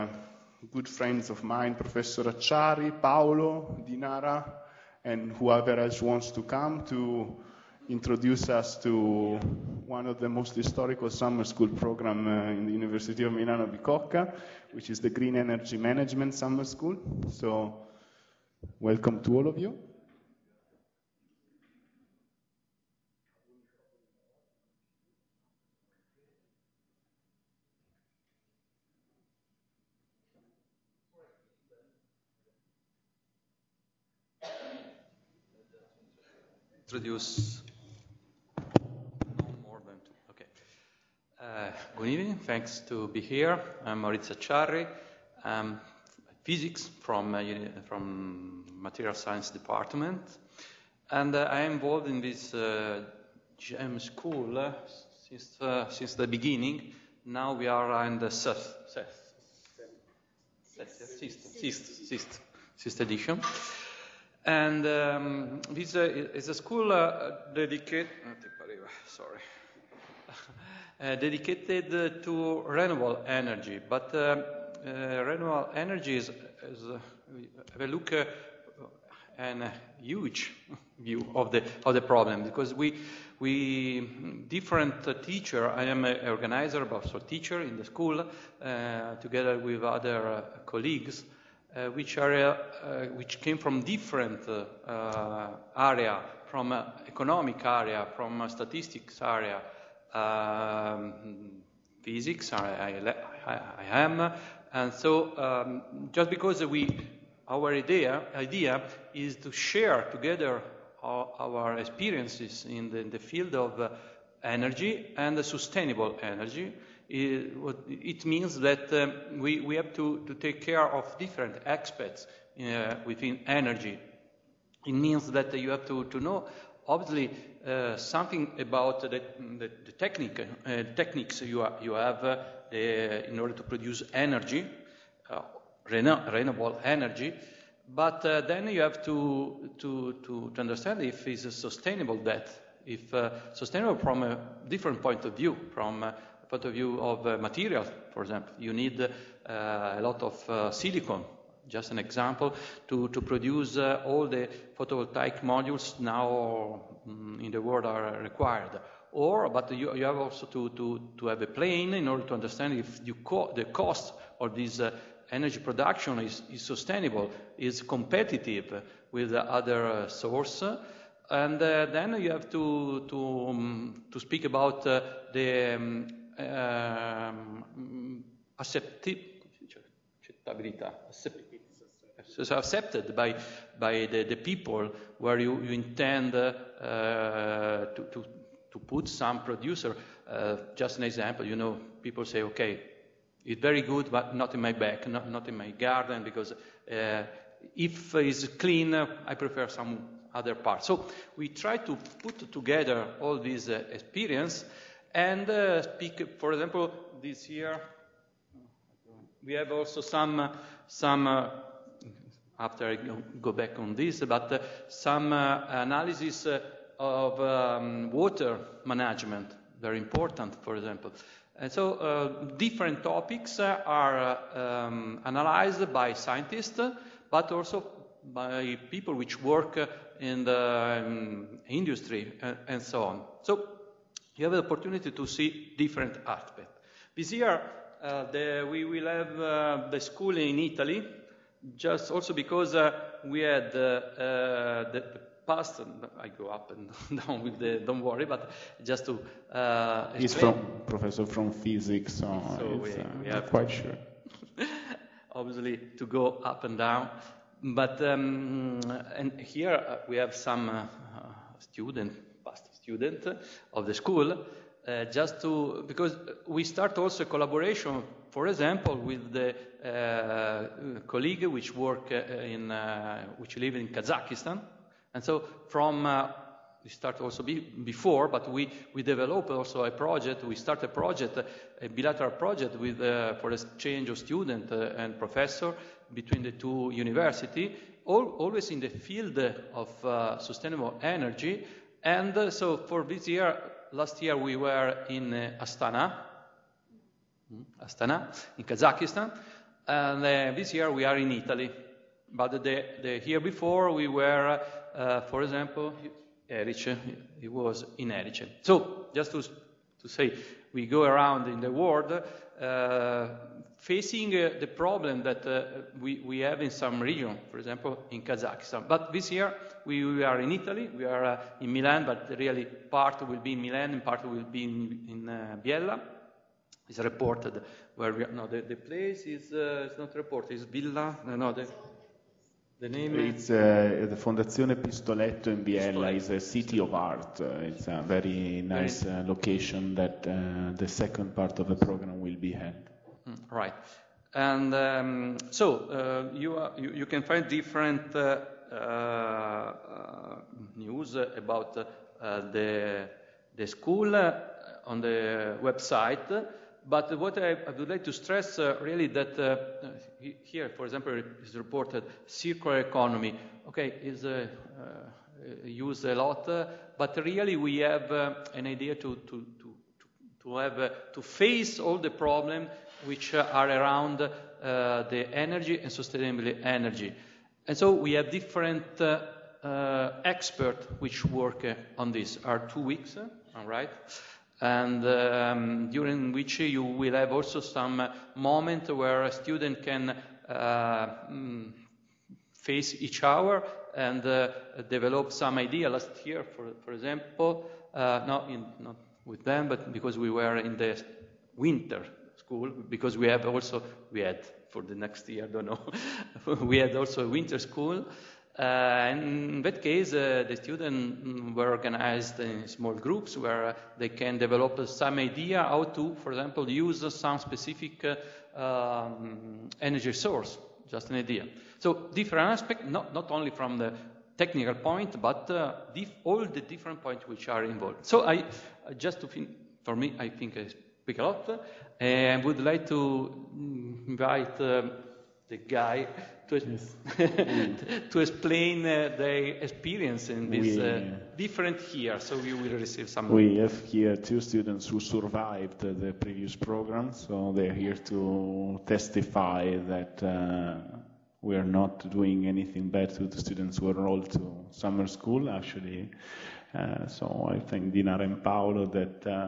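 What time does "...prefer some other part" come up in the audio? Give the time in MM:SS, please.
03:19.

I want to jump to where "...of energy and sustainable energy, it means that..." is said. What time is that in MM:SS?
01:53.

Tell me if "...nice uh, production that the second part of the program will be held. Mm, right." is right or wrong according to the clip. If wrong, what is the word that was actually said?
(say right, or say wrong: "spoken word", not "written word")
wrong: "location", not "production".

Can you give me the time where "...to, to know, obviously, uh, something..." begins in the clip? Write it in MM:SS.
02:05.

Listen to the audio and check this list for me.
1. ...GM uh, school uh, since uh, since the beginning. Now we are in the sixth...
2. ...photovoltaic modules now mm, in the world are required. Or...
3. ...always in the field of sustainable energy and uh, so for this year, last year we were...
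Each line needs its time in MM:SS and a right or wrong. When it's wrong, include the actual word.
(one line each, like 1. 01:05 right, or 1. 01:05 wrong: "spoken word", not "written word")
1. 00:52 right
2. 02:34 right
3. 04:48 right.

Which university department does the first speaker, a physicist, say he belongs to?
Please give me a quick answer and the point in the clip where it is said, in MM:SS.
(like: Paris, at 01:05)
Material Science Department, at 00:48.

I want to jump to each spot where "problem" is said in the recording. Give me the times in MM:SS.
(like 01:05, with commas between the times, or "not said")
01:22, 05:14, 06:12.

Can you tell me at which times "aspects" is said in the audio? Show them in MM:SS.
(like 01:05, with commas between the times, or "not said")
02:01, 03:56, 07:02.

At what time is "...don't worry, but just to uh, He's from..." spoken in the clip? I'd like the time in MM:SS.
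04:07.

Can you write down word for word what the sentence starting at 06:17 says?
And so we have different uh, uh, experts which work on this.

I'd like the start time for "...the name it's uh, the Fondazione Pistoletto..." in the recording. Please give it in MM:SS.
05:32.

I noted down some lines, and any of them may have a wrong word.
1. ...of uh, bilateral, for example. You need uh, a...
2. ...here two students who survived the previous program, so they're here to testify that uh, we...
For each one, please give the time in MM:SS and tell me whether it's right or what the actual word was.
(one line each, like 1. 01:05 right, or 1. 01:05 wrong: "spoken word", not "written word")
1. 02:27 wrong: "material", not "bilateral"
2. 07:23 right.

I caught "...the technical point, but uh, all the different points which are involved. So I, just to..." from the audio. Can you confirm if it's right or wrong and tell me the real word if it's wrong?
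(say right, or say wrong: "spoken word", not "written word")
right.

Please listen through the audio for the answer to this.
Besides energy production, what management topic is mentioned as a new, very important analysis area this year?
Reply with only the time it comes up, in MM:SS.
03:38.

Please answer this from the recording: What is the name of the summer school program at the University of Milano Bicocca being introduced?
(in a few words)
Green Energy Management Summer School.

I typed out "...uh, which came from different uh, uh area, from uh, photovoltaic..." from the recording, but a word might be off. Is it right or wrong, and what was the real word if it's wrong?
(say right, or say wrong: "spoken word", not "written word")
wrong: "economic", not "photovoltaic".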